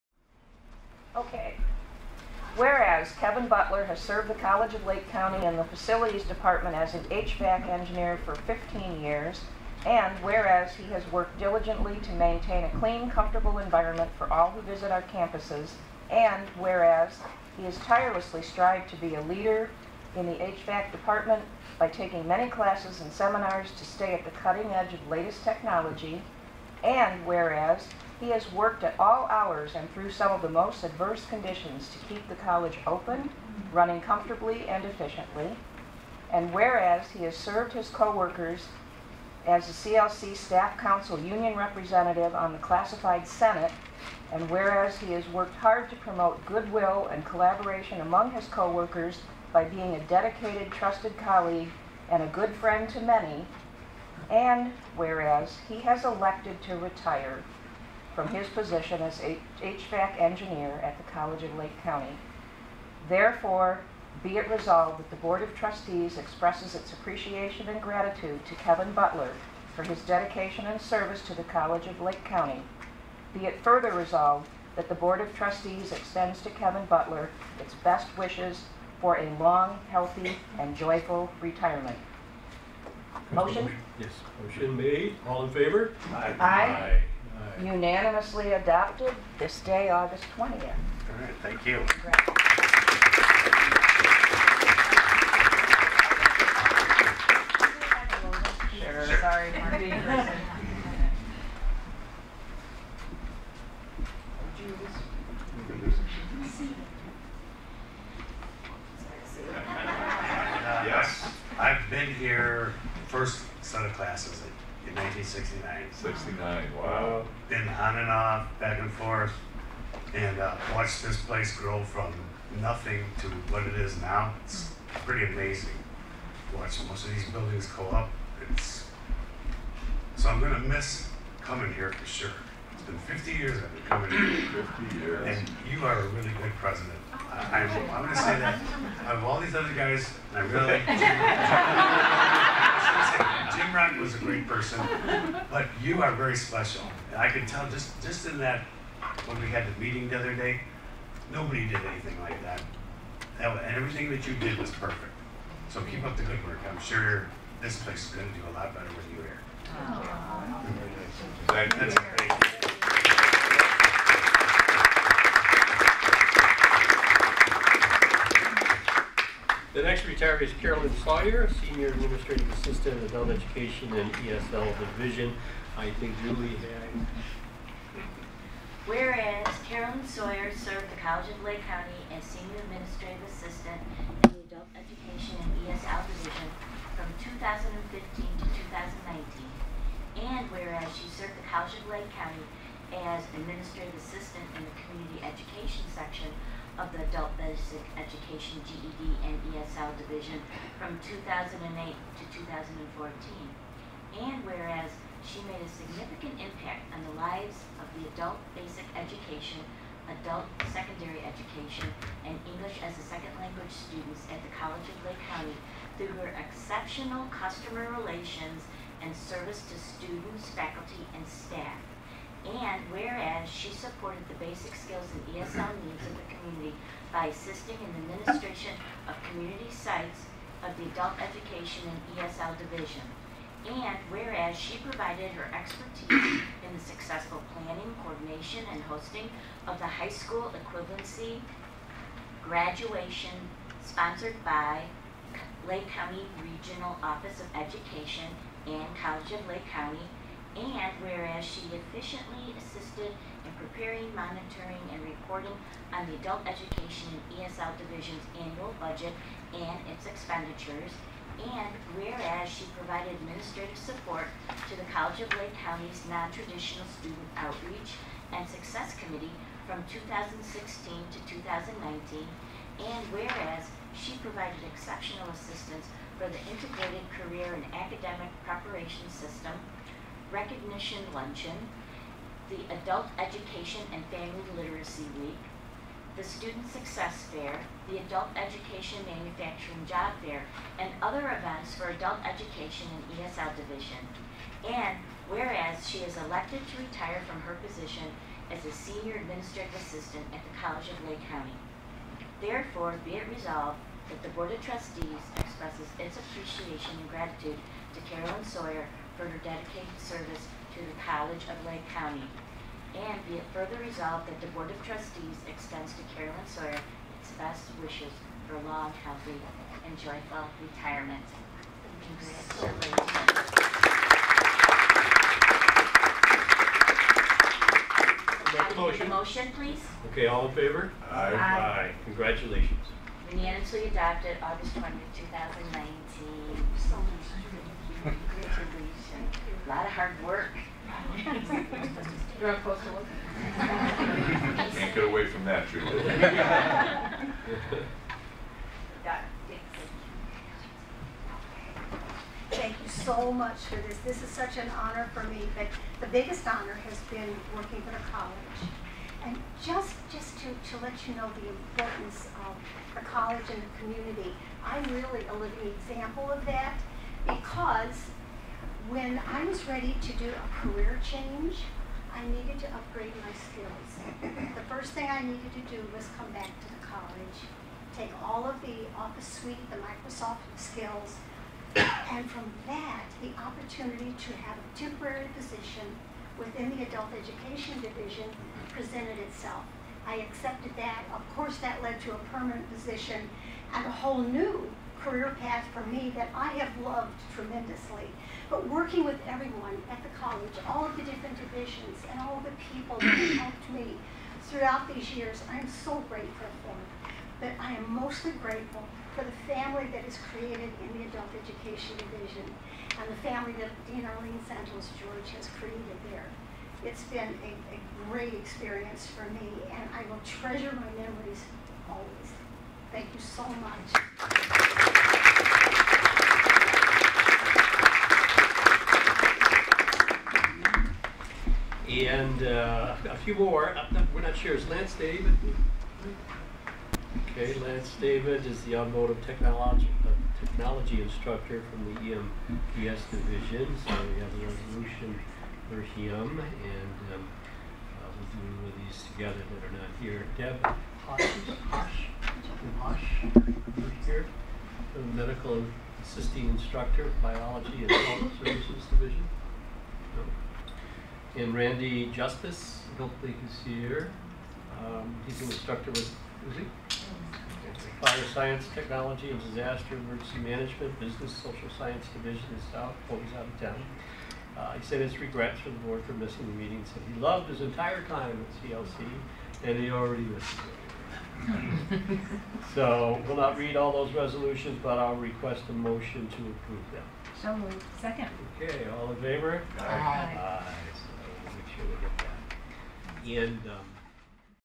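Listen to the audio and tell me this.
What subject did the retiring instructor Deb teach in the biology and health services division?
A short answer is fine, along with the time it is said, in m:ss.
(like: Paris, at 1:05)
Medical assisting, at 7:35.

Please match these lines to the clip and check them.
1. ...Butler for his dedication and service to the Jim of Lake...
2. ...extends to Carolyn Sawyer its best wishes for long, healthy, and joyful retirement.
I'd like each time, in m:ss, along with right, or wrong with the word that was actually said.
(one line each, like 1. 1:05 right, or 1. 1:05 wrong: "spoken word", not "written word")
1. 1:08 wrong: "College", not "Jim"
2. 5:15 right.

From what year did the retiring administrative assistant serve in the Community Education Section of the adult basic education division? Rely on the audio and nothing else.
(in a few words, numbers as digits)
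2008.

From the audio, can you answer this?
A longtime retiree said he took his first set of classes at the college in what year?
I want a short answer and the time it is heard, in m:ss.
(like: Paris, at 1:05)
1969, at 1:54.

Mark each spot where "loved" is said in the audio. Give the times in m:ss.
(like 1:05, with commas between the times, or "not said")
6:36, 7:57.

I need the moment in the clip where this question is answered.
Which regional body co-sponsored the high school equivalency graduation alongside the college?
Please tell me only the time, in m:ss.
4:05.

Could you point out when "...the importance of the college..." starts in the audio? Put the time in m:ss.
6:01.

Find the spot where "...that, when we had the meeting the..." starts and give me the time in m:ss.
2:28.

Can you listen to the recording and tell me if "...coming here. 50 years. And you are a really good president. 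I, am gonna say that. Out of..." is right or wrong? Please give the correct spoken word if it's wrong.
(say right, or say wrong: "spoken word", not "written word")
right.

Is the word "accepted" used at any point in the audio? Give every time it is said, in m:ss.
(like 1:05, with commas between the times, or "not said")
6:30.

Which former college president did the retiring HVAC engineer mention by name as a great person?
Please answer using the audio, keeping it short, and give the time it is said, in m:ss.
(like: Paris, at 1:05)
Jim Wright, at 2:23.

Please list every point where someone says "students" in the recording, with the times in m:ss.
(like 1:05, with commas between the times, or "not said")
3:33, 3:39, 4:26, 4:46.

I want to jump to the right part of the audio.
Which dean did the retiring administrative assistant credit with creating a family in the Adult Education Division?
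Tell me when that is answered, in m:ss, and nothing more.
6:54.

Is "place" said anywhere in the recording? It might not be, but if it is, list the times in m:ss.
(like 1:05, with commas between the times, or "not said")
2:01, 2:37.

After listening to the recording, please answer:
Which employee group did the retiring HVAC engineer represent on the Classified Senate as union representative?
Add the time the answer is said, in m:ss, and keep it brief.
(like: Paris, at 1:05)
CLC Staff Council, at 0:39.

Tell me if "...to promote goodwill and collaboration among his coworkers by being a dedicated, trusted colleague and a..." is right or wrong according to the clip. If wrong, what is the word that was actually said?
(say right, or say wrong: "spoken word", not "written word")
right.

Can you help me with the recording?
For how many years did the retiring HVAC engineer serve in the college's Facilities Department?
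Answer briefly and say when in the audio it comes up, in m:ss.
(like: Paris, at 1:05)
15, at 0:08.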